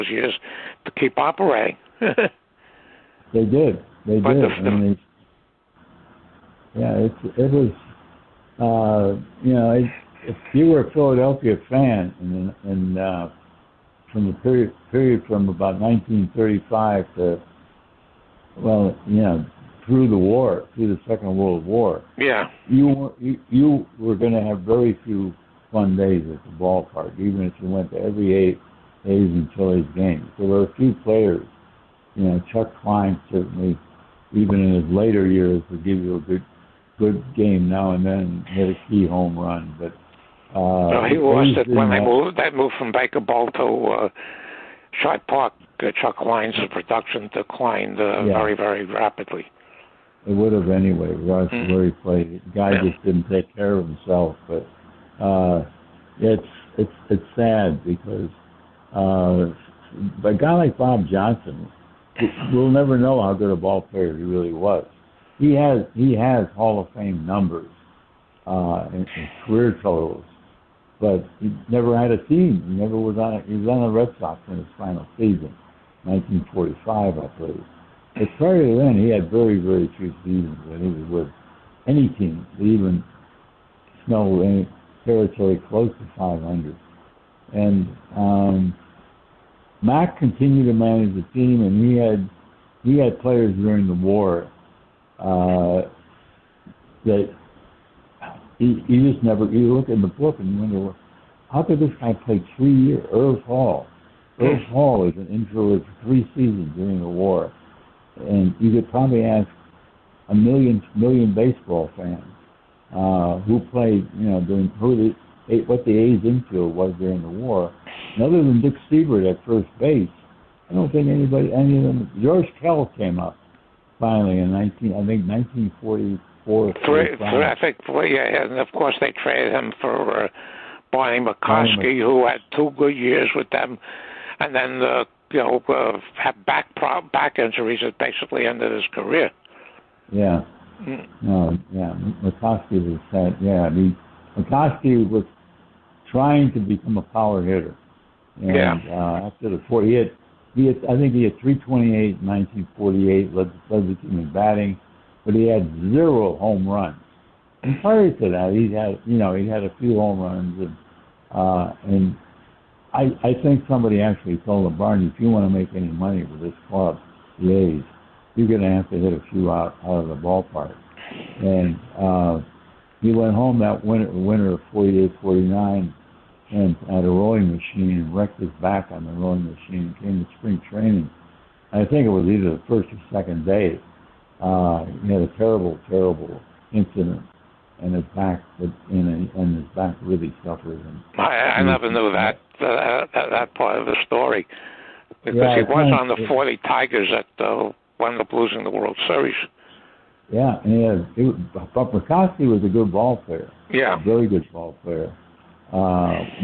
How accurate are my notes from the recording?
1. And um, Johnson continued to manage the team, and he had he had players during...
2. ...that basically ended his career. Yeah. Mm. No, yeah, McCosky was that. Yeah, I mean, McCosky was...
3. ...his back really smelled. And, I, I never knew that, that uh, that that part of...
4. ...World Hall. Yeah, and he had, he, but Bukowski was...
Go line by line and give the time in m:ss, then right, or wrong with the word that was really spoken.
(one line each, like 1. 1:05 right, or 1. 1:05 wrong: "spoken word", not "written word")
1. 1:27 wrong: "Mack", not "Johnson"
2. 2:17 right
3. 3:09 wrong: "suffered", not "smelled"
4. 3:18 wrong: "Series", not "Hall".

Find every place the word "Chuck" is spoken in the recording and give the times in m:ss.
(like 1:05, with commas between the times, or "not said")
0:32, 0:46.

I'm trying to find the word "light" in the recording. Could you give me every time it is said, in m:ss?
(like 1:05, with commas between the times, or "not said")
not said.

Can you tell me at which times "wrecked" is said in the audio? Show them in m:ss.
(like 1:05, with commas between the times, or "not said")
2:58.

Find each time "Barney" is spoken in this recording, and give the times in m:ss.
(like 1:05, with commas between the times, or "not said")
2:10, 2:44.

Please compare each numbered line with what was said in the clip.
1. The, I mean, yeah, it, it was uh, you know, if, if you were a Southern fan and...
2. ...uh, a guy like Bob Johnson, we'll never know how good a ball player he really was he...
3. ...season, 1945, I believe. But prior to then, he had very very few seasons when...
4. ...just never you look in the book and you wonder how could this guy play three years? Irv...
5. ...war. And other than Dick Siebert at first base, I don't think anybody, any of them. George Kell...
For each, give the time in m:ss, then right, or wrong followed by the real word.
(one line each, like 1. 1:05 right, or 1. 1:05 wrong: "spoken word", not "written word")
1. 0:04 wrong: "Philadelphia", not "Southern"
2. 0:58 right
3. 1:15 right
4. 1:39 right
5. 1:57 right.